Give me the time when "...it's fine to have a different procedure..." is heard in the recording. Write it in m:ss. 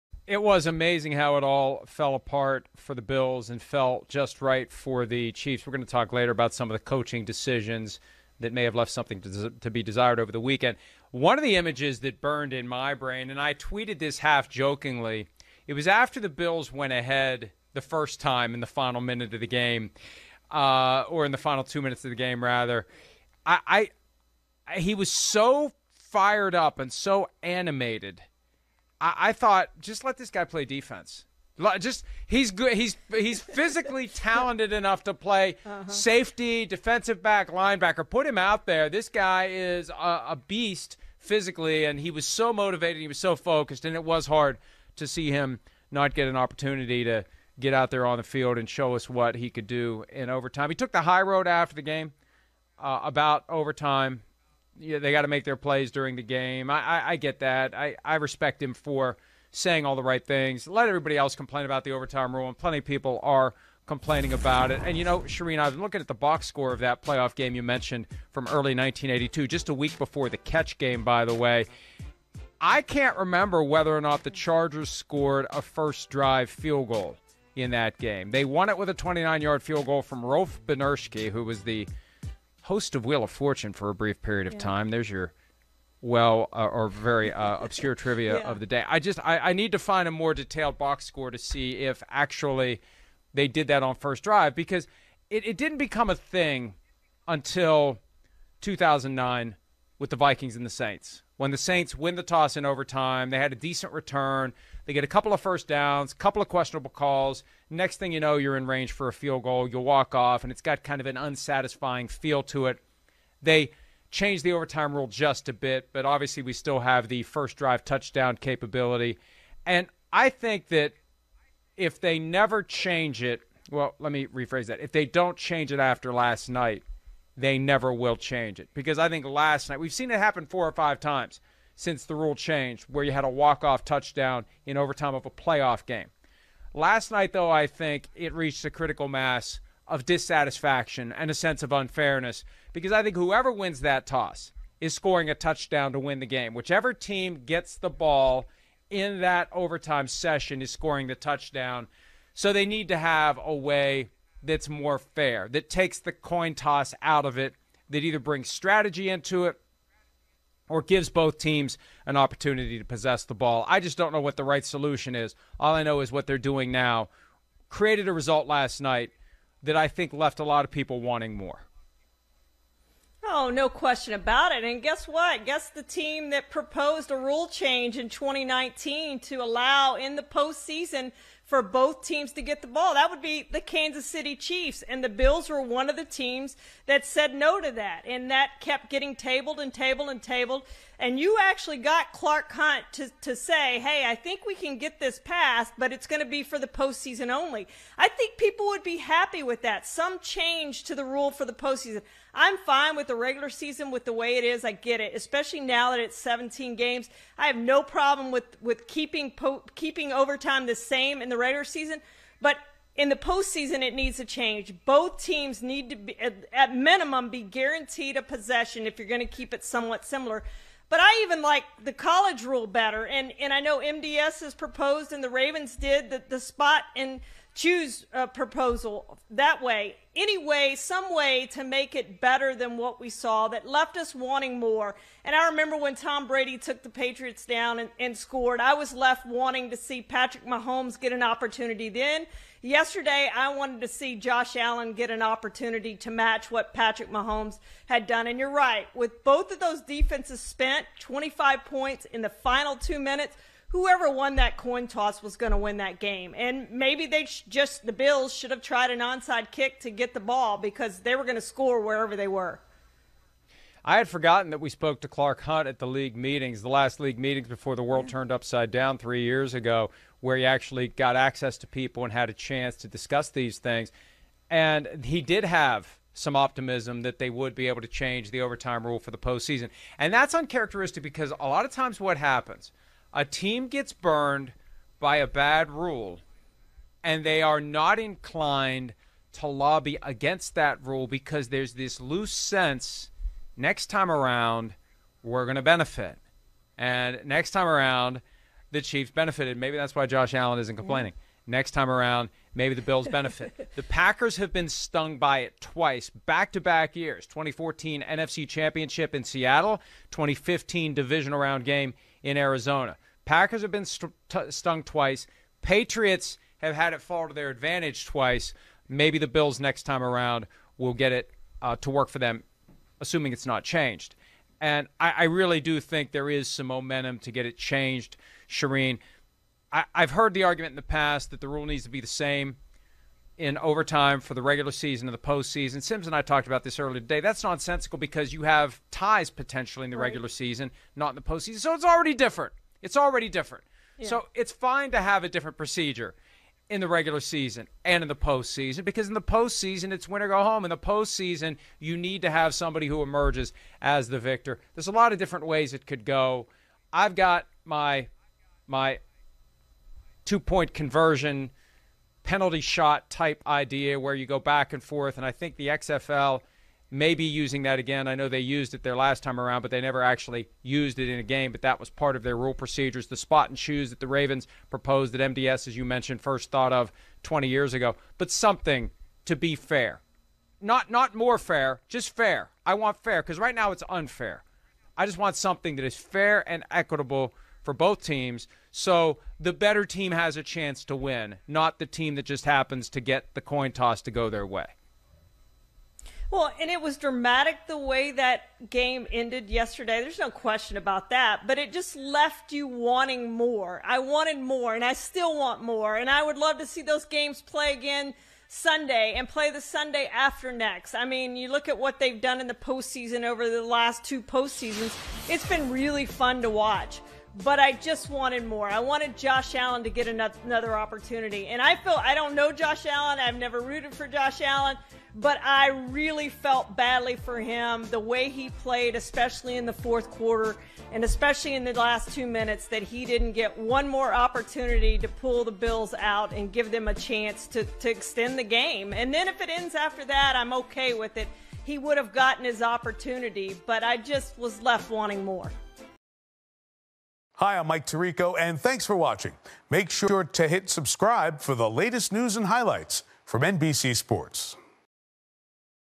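5:44.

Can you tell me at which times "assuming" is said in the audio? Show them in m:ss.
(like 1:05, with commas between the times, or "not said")
5:22.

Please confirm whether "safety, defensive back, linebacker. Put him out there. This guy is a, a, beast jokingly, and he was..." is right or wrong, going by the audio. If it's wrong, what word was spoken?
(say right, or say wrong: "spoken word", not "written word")
wrong: "physically", not "jokingly".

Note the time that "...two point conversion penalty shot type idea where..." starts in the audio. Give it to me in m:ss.
6:00.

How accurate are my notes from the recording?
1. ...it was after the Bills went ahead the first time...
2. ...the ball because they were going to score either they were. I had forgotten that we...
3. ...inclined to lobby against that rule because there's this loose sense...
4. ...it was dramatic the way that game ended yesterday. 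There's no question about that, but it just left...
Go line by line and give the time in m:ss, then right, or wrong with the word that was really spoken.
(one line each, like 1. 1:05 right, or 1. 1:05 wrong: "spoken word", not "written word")
1. 0:15 right
2. 4:20 wrong: "wherever", not "either"
3. 4:47 right
4. 6:36 right.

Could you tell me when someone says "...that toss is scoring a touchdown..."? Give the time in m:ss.
2:23.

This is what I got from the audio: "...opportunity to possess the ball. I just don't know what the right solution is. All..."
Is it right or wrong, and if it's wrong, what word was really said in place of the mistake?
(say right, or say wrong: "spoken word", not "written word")
right.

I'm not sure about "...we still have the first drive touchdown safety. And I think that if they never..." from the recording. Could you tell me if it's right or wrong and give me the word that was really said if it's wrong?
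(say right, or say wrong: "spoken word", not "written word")
wrong: "capability", not "safety".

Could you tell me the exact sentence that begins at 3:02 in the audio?
That would be the Kansas City Chiefs.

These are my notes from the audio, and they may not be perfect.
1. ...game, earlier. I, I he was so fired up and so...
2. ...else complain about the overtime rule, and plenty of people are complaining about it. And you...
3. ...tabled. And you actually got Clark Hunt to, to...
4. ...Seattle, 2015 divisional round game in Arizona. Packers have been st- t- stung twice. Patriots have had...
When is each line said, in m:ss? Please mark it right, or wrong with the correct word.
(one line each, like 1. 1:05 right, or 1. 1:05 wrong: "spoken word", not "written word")
1. 0:22 wrong: "rather", not "earlier"
2. 1:01 right
3. 3:10 right
4. 5:09 right.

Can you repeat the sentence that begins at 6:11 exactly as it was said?
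But that was part of their rule procedures.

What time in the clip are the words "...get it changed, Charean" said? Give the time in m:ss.
5:27.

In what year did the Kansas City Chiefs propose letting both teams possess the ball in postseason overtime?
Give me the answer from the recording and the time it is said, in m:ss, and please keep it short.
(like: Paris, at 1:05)
2019, at 2:58.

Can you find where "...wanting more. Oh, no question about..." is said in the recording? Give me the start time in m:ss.
2:51.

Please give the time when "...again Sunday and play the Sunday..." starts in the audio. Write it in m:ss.
6:47.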